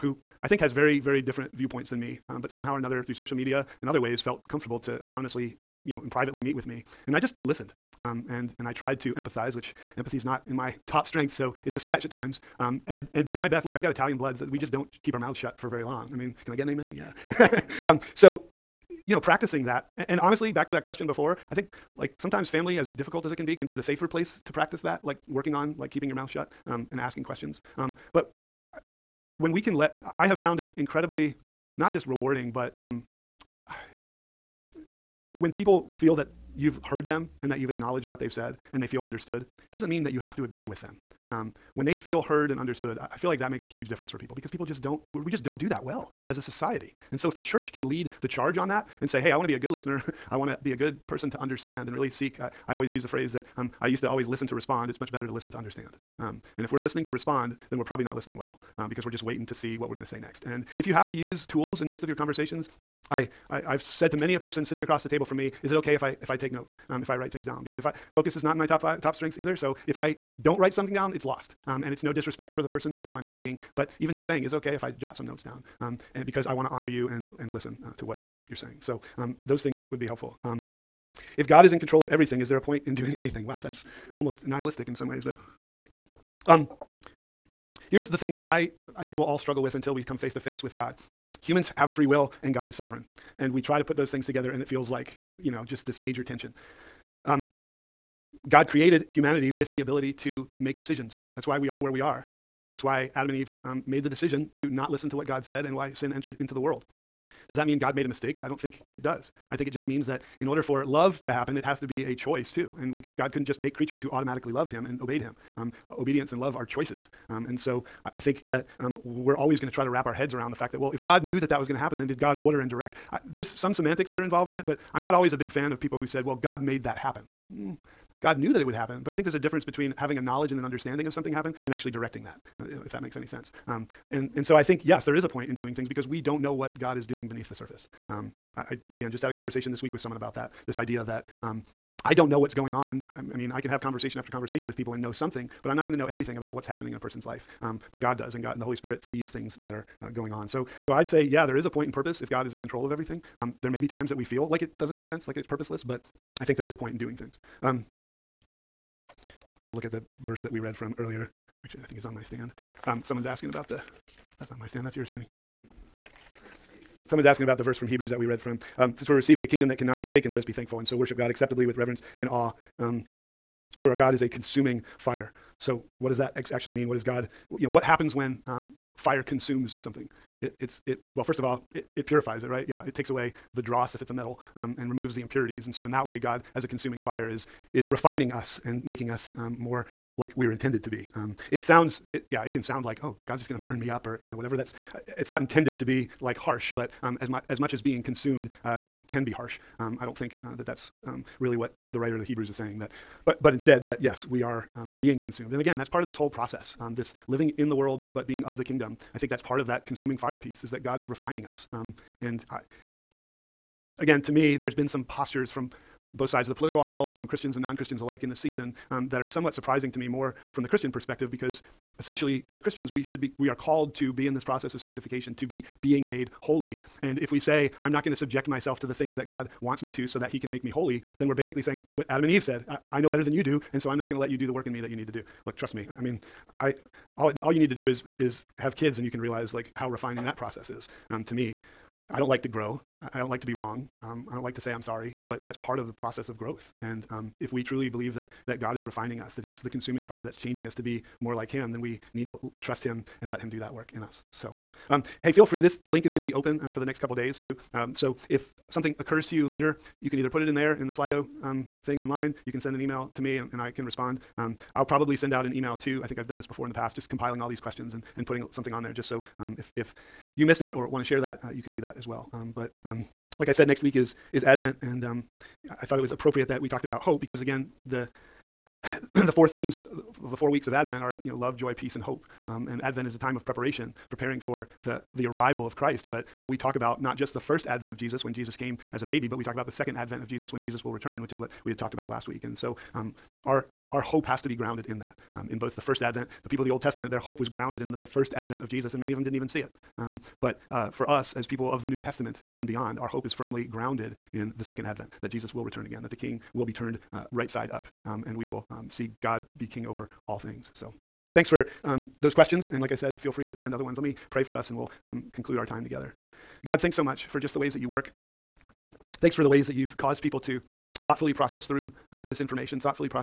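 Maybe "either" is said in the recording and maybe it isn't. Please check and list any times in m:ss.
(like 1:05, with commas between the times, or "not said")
1:09, 4:20.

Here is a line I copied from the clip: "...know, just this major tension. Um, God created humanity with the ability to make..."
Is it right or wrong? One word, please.
right.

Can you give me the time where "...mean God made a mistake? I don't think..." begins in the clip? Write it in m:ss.
1:47.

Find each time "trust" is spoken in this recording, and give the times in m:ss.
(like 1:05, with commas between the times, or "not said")
3:55, 4:12.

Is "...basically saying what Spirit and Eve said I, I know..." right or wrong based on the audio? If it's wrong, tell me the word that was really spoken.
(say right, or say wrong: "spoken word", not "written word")
wrong: "Adam", not "Spirit".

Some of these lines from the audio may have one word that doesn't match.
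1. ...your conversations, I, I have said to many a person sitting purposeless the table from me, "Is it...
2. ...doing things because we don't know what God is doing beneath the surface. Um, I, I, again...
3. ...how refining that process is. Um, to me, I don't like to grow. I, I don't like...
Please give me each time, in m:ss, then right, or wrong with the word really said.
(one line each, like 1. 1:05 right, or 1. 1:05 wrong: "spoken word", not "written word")
1. 1:02 wrong: "across", not "purposeless"
2. 2:15 right
3. 3:59 right.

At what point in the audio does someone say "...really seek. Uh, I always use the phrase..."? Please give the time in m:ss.
0:51.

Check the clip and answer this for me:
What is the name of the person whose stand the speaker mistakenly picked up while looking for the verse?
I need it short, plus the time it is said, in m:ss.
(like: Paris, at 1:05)
Kenny, at 2:45.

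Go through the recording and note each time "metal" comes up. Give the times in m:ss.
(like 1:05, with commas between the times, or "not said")
3:04.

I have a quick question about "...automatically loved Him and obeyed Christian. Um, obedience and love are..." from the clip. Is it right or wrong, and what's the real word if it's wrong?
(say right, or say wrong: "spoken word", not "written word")
wrong: "Him", not "Christian".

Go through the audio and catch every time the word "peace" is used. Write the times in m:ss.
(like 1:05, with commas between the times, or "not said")
4:41.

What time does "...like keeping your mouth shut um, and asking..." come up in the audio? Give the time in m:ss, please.
0:25.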